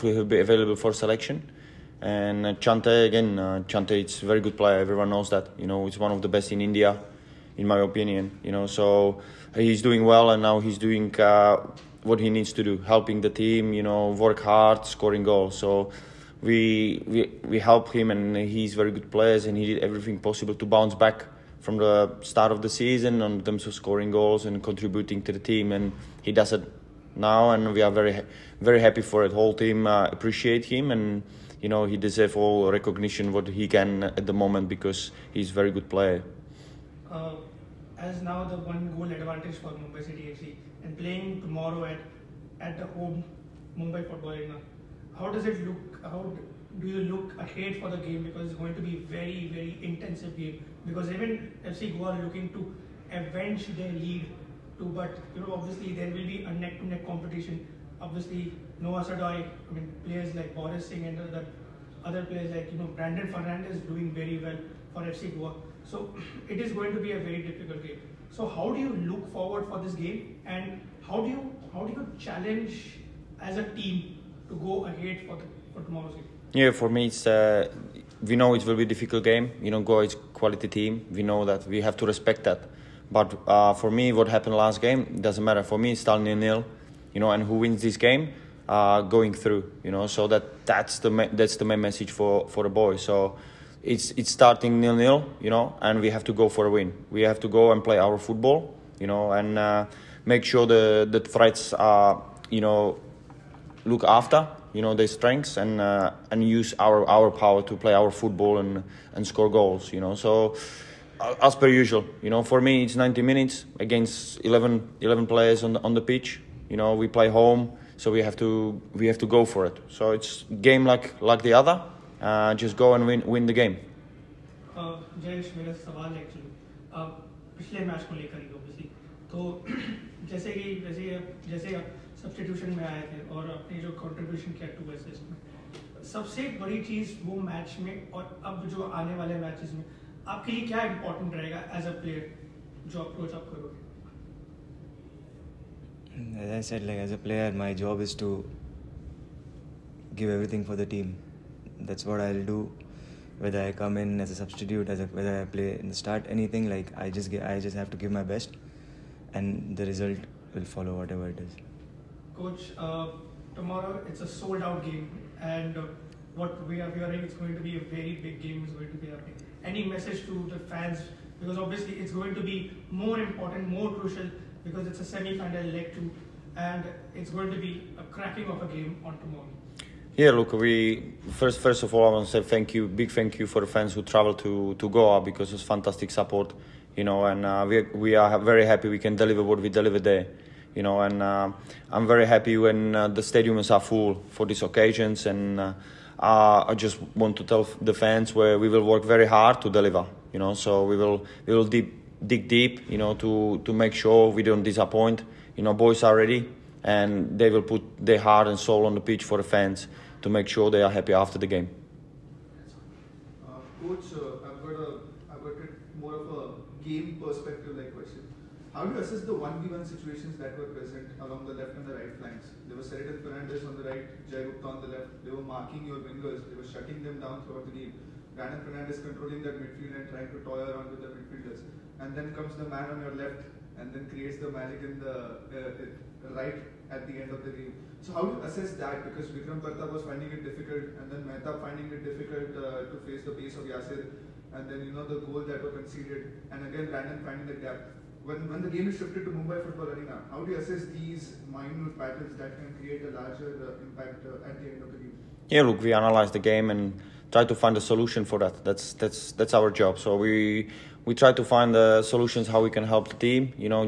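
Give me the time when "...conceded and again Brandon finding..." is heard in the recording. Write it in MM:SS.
04:05.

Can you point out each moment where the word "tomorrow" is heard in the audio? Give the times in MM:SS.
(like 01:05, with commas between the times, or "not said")
00:41, 01:15, 02:43, 02:59.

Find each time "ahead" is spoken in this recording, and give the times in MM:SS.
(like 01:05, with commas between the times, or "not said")
00:47, 01:14.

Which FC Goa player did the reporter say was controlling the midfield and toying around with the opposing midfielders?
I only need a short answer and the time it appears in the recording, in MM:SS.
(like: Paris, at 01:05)
Brandon Fernandes, at 03:48.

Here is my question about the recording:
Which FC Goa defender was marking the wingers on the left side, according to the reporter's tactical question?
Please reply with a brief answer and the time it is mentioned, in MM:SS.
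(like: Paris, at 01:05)
Jay Gupta, at 03:44.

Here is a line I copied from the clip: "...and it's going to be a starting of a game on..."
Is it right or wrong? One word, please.
wrong.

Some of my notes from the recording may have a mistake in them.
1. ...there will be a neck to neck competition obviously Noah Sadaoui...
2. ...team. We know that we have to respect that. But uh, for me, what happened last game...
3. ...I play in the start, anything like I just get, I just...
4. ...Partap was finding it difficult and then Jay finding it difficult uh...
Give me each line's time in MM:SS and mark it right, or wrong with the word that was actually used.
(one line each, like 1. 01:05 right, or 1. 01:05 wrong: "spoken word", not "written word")
1. 00:55 right
2. 01:20 right
3. 02:35 right
4. 03:59 wrong: "Mehta", not "Jay".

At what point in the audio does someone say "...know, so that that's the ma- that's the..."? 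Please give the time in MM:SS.
01:29.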